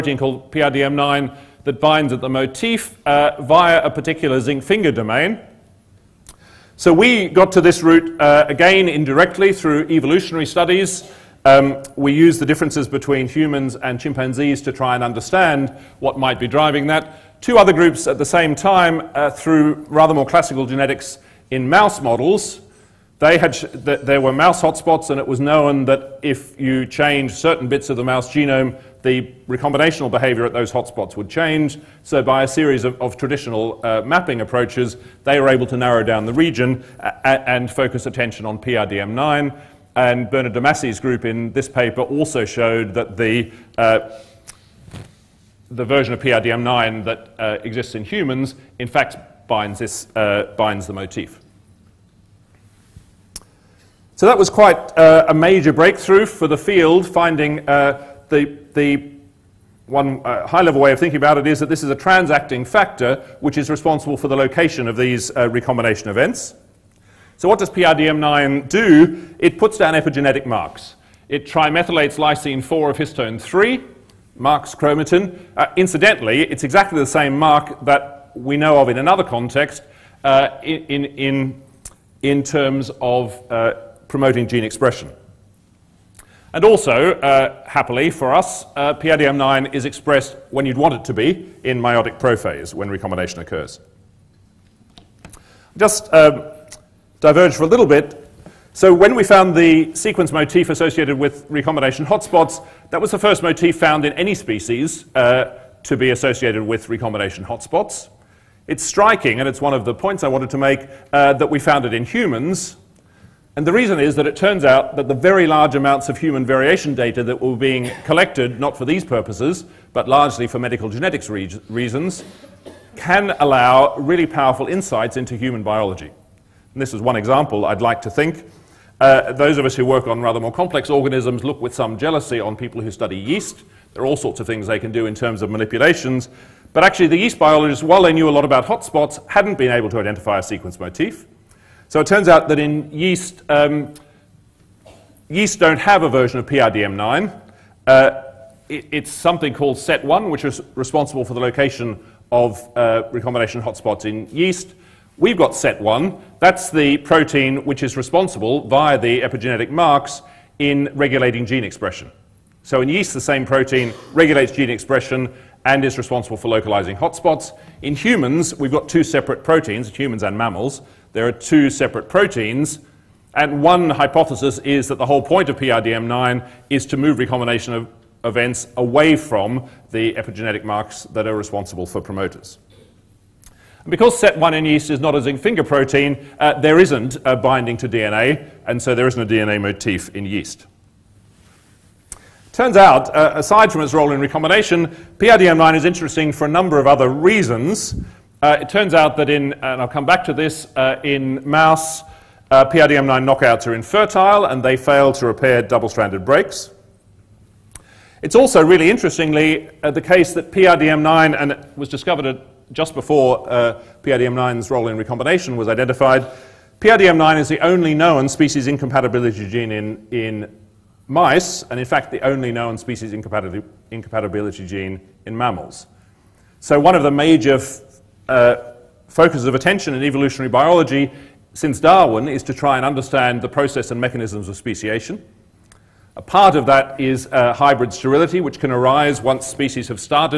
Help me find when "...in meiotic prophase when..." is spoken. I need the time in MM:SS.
01:31.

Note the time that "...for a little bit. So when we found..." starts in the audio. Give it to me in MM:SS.
01:37.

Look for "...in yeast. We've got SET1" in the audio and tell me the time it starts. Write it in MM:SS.
02:34.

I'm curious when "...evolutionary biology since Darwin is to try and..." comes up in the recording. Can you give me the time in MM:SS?
03:50.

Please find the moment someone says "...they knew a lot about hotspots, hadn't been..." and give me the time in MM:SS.
02:18.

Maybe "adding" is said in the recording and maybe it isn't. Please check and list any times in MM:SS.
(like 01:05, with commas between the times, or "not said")
not said.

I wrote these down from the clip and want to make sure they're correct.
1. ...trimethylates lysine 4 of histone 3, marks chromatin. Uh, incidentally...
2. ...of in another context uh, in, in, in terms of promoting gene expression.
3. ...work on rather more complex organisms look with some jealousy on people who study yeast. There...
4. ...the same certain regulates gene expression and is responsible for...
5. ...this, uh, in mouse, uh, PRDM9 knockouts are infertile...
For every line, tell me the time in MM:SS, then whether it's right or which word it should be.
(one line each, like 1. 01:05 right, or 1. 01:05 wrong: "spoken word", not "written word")
1. 01:11 right
2. 01:18 right
3. 02:09 right
4. 02:43 wrong: "protein", not "certain"
5. 03:20 right.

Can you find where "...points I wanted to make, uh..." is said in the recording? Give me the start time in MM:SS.
01:49.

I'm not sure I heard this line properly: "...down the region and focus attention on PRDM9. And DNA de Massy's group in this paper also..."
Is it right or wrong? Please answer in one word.
wrong.